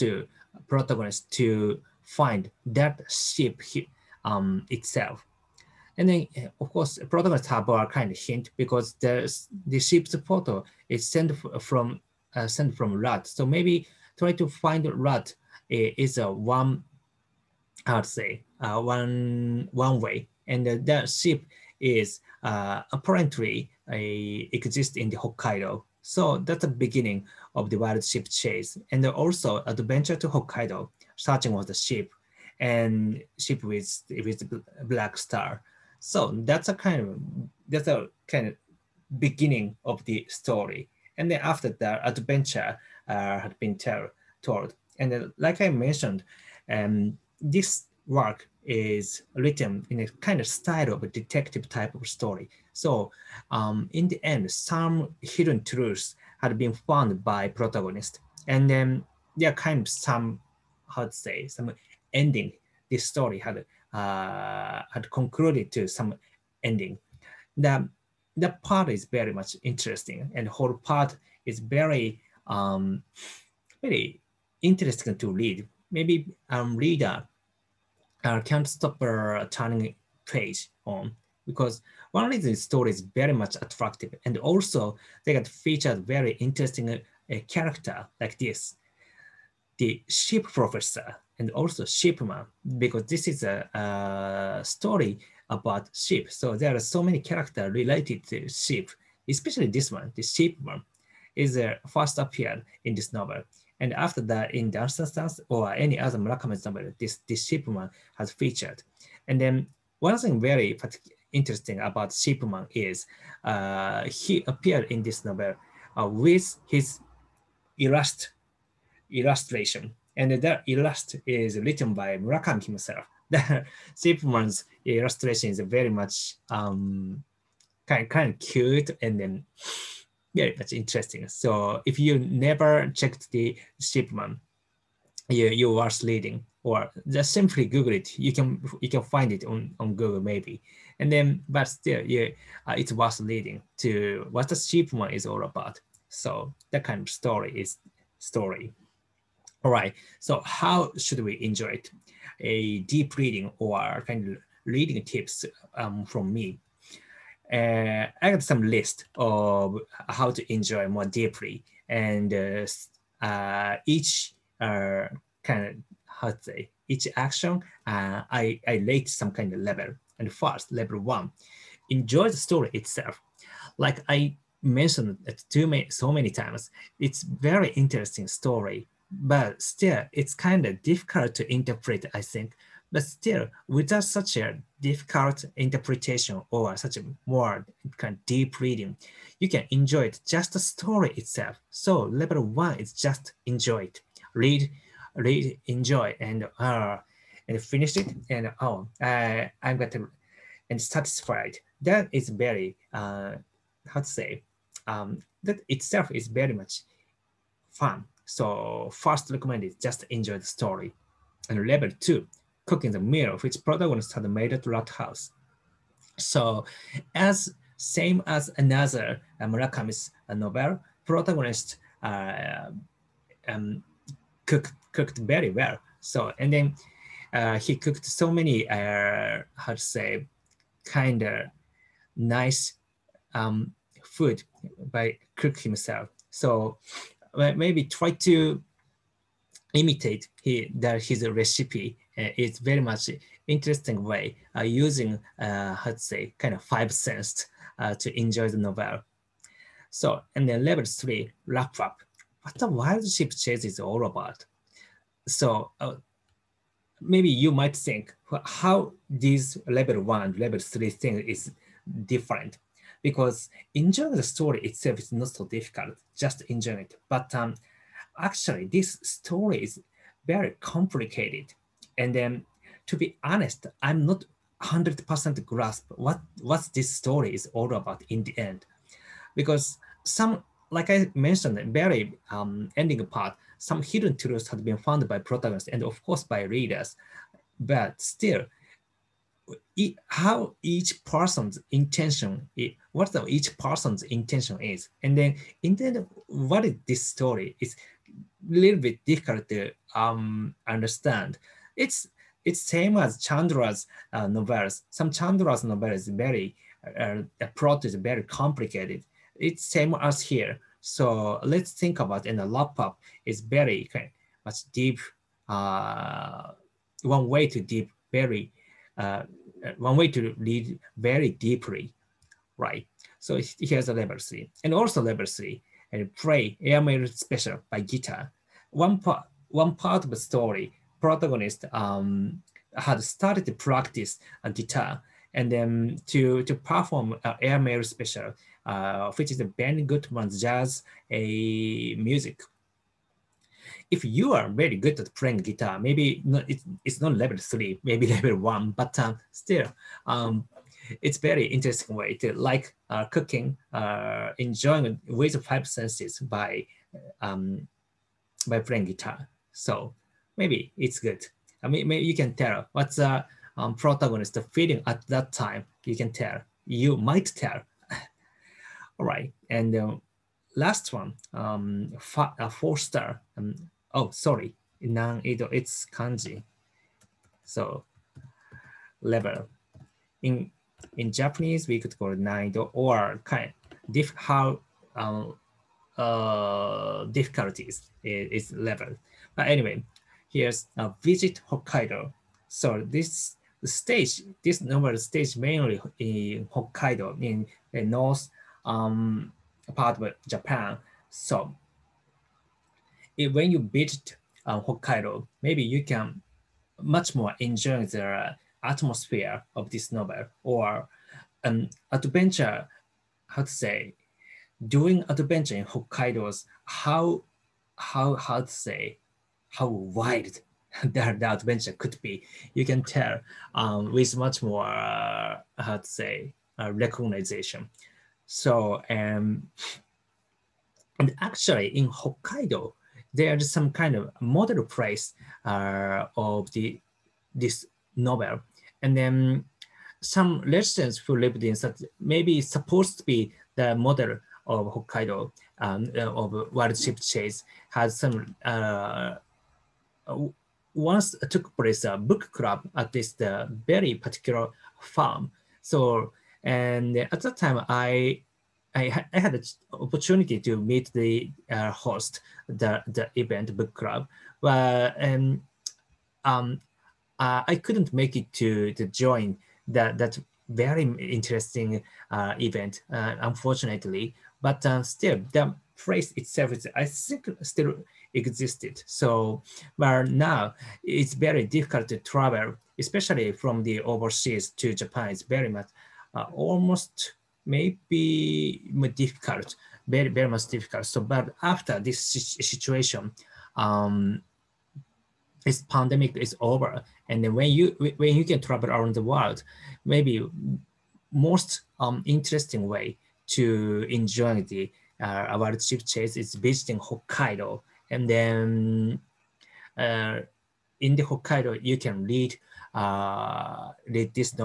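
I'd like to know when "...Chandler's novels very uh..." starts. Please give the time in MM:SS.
05:05.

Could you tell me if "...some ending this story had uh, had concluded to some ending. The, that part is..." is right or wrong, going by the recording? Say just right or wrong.
right.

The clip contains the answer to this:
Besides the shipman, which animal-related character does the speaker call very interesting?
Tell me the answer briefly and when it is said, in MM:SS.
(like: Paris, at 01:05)
the ship professor, at 01:30.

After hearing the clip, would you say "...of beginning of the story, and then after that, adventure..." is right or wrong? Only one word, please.
right.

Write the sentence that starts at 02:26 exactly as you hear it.
So that kind of story is story.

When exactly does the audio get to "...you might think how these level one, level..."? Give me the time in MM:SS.
04:17.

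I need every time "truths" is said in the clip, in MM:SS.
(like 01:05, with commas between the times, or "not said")
00:55, 04:44.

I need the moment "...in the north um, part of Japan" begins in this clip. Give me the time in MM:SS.
06:37.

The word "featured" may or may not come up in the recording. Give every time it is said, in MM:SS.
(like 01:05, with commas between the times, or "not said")
01:25, 01:48.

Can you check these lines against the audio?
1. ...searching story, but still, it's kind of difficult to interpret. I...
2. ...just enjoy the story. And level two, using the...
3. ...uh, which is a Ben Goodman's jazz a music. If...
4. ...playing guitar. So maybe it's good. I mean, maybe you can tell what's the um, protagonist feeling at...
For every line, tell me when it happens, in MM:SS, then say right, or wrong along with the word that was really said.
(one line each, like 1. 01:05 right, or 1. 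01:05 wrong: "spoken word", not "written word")
1. 02:57 wrong: "interesting", not "searching"
2. 03:29 wrong: "cooking", not "using"
3. 05:38 right
4. 05:58 right.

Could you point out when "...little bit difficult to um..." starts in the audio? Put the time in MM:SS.
04:58.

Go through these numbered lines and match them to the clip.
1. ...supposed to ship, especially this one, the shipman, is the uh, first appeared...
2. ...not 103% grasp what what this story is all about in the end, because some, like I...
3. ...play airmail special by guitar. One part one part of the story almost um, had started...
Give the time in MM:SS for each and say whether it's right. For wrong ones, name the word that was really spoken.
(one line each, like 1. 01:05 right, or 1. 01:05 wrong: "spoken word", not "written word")
1. 01:37 wrong: "related", not "supposed"
2. 04:34 wrong: "100", not "103"
3. 05:26 wrong: "protagonist", not "almost".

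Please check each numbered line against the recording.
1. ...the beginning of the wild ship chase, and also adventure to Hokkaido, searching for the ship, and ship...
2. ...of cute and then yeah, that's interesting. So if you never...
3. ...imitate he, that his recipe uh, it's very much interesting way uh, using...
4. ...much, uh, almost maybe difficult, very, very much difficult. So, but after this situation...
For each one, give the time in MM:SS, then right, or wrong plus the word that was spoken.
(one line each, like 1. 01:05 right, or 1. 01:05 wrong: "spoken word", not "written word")
1. 00:26 right
2. 02:08 right
3. 03:59 right
4. 08:05 right.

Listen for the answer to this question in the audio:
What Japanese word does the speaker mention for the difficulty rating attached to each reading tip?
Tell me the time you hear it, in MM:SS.
06:22.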